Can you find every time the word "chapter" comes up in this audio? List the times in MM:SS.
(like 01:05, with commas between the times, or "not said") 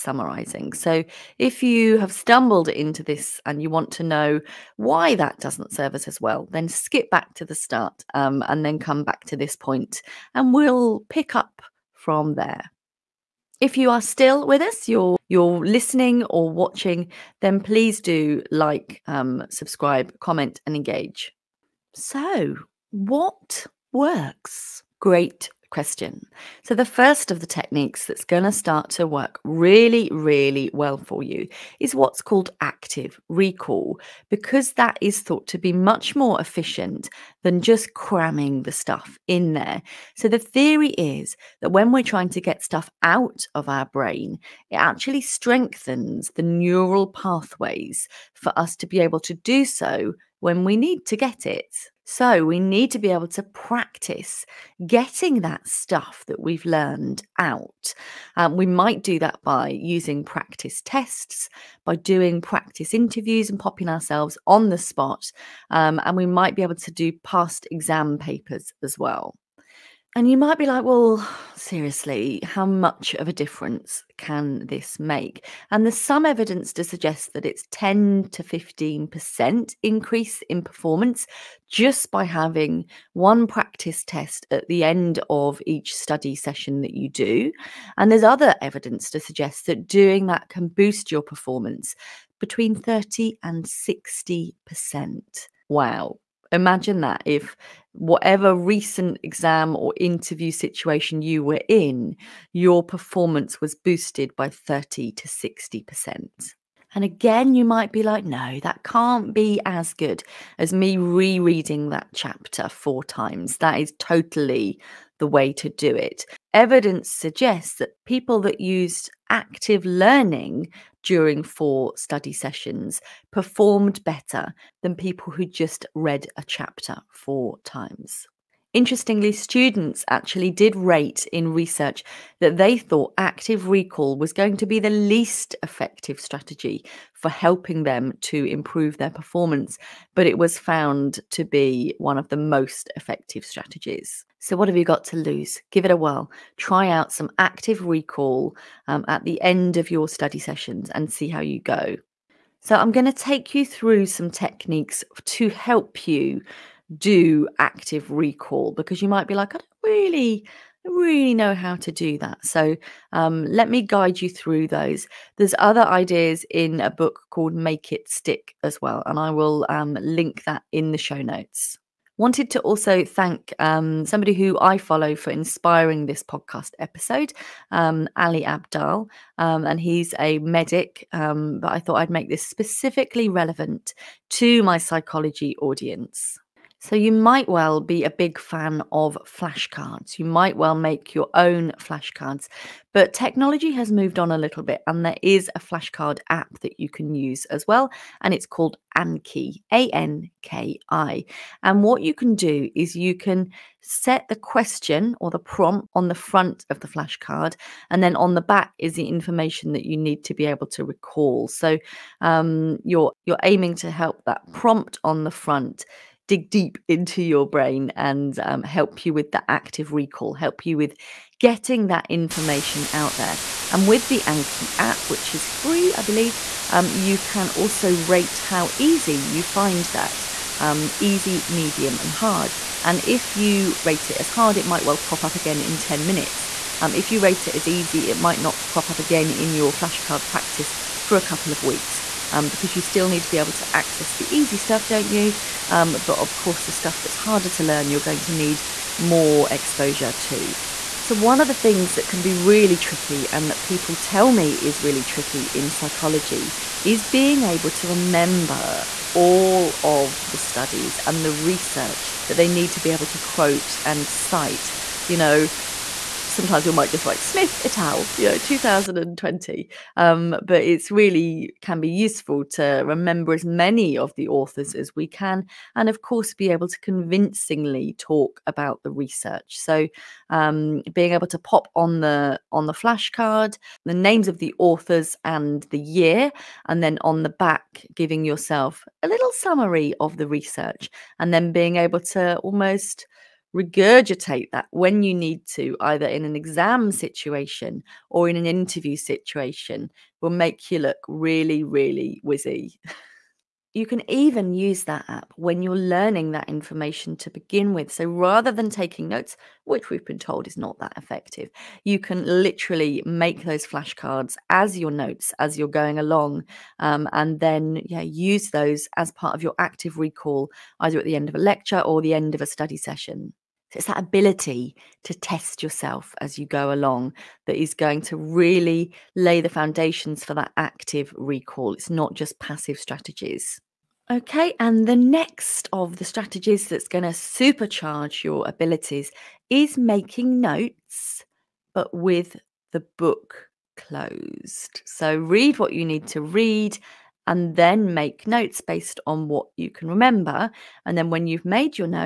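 01:52, 02:06.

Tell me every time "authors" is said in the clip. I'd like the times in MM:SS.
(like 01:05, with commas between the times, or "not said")
04:34, 04:44.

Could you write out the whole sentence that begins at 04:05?
Um, but of course, the stuff that's harder to learn, you're going to need more exposure to.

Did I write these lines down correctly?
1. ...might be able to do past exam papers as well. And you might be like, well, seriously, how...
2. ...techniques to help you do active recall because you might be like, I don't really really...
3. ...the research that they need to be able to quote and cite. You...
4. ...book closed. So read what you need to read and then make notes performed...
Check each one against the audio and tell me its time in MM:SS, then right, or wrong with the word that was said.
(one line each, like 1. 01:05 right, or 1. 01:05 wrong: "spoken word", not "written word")
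1. 01:06 right
2. 02:34 right
3. 04:21 right
4. 05:42 wrong: "based", not "performed".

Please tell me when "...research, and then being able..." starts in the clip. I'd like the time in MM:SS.
04:50.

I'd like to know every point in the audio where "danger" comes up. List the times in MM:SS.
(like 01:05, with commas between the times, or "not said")
not said.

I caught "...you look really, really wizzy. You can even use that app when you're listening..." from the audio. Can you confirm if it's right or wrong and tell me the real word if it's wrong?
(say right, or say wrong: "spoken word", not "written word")
wrong: "learning", not "listening".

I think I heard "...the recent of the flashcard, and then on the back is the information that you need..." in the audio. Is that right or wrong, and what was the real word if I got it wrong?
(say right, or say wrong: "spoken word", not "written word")
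wrong: "front", not "recent".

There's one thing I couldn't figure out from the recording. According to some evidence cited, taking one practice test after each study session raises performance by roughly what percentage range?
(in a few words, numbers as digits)
10 to 15%.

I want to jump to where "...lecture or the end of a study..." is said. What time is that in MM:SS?
05:21.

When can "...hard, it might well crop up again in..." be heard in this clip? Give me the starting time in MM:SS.
03:54.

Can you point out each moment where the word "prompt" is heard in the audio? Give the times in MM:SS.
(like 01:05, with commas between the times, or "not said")
03:25, 03:34.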